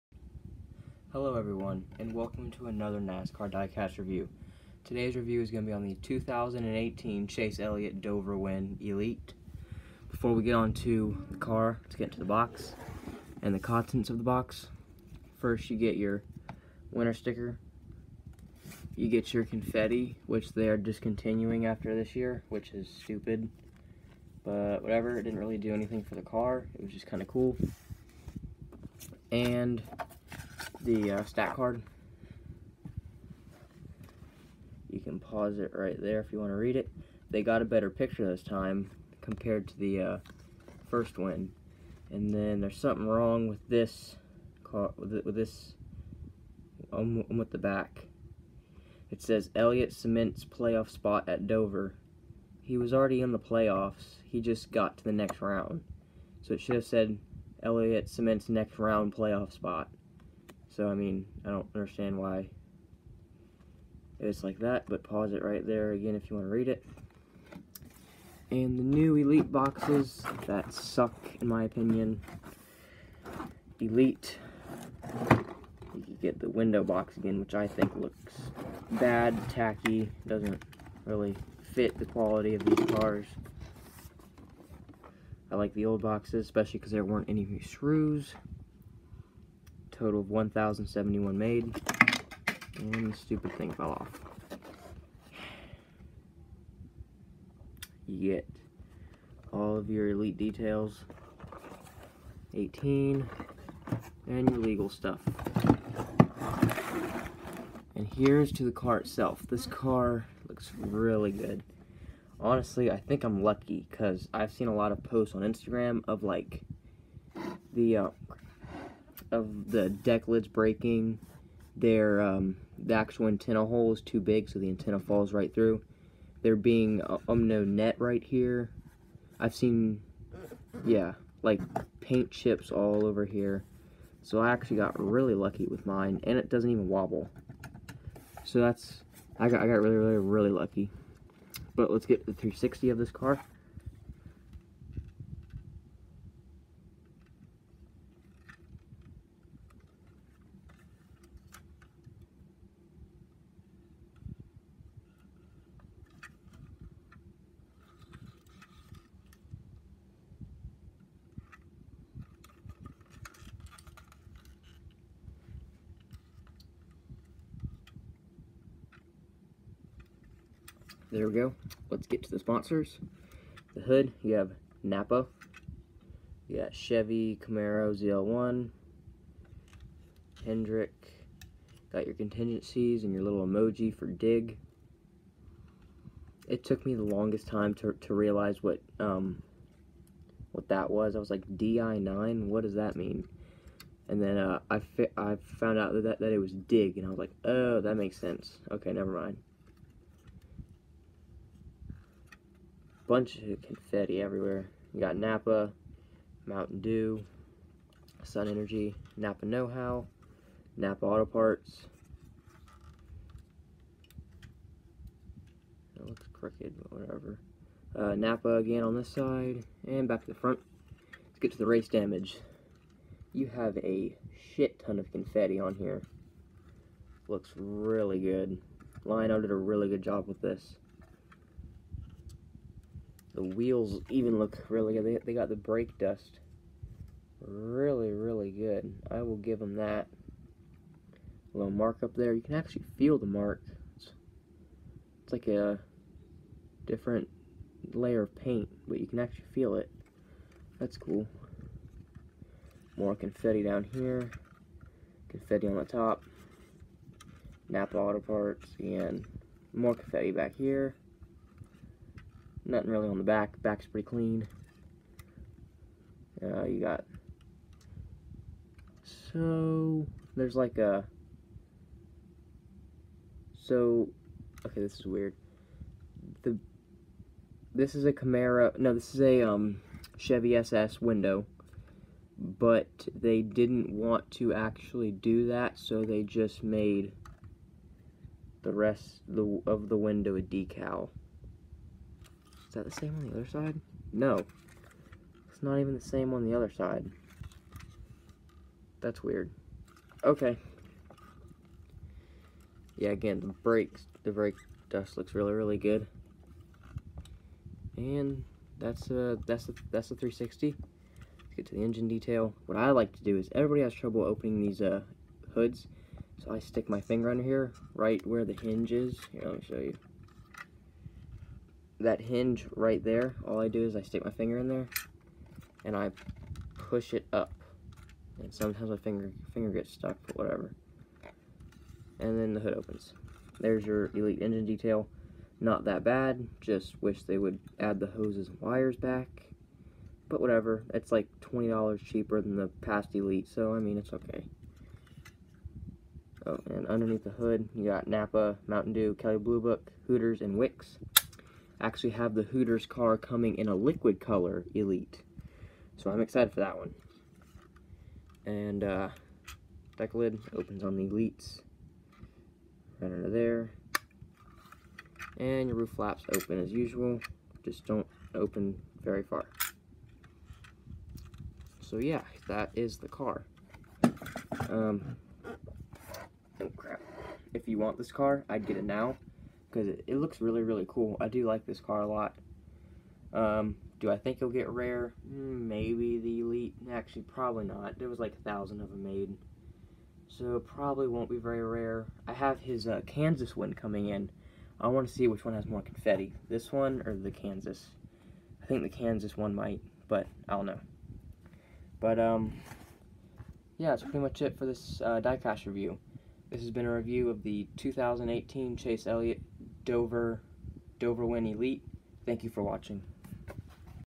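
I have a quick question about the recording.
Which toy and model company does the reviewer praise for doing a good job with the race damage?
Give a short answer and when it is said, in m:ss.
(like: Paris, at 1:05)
Lionel, at 3:49.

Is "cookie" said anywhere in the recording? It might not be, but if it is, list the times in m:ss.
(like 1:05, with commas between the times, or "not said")
not said.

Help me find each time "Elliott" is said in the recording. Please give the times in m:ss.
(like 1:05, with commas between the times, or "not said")
0:07, 0:49, 0:57, 6:49.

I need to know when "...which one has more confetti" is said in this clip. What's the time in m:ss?
6:35.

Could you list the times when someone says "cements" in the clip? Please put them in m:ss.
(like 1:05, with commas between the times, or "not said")
0:49, 0:58.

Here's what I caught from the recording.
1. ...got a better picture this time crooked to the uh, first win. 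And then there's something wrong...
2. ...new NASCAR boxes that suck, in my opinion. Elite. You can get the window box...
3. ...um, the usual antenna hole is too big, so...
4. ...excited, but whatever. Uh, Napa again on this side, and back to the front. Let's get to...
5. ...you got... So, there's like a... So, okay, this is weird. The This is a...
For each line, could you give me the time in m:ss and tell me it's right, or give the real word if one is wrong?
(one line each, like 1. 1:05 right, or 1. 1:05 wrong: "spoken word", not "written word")
1. 0:37 wrong: "compared", not "crooked"
2. 1:08 wrong: "Elite", not "NASCAR"
3. 2:02 wrong: "actual", not "usual"
4. 3:36 wrong: "crooked", not "excited"
5. 4:26 right.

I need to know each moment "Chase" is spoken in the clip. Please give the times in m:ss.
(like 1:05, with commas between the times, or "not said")
0:07, 6:48.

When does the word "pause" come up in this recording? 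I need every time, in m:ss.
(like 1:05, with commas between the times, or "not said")
0:35, 1:05.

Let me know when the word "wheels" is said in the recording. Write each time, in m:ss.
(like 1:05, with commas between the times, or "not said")
3:53.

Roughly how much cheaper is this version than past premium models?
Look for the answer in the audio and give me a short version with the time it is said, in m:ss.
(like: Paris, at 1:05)
$20, at 5:41.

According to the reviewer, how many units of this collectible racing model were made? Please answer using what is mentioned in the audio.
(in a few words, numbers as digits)
1,071.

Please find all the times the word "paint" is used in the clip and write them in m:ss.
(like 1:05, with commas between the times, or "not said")
2:11, 4:08.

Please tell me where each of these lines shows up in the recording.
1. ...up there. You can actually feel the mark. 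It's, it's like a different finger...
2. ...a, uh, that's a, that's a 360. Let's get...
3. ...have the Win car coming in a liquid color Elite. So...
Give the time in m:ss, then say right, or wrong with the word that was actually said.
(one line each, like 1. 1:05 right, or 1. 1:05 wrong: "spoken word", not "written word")
1. 4:02 wrong: "layer", not "finger"
2. 5:09 right
3. 5:52 wrong: "Hooters", not "Win".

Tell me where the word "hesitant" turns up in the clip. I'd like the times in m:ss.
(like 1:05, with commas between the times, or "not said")
not said.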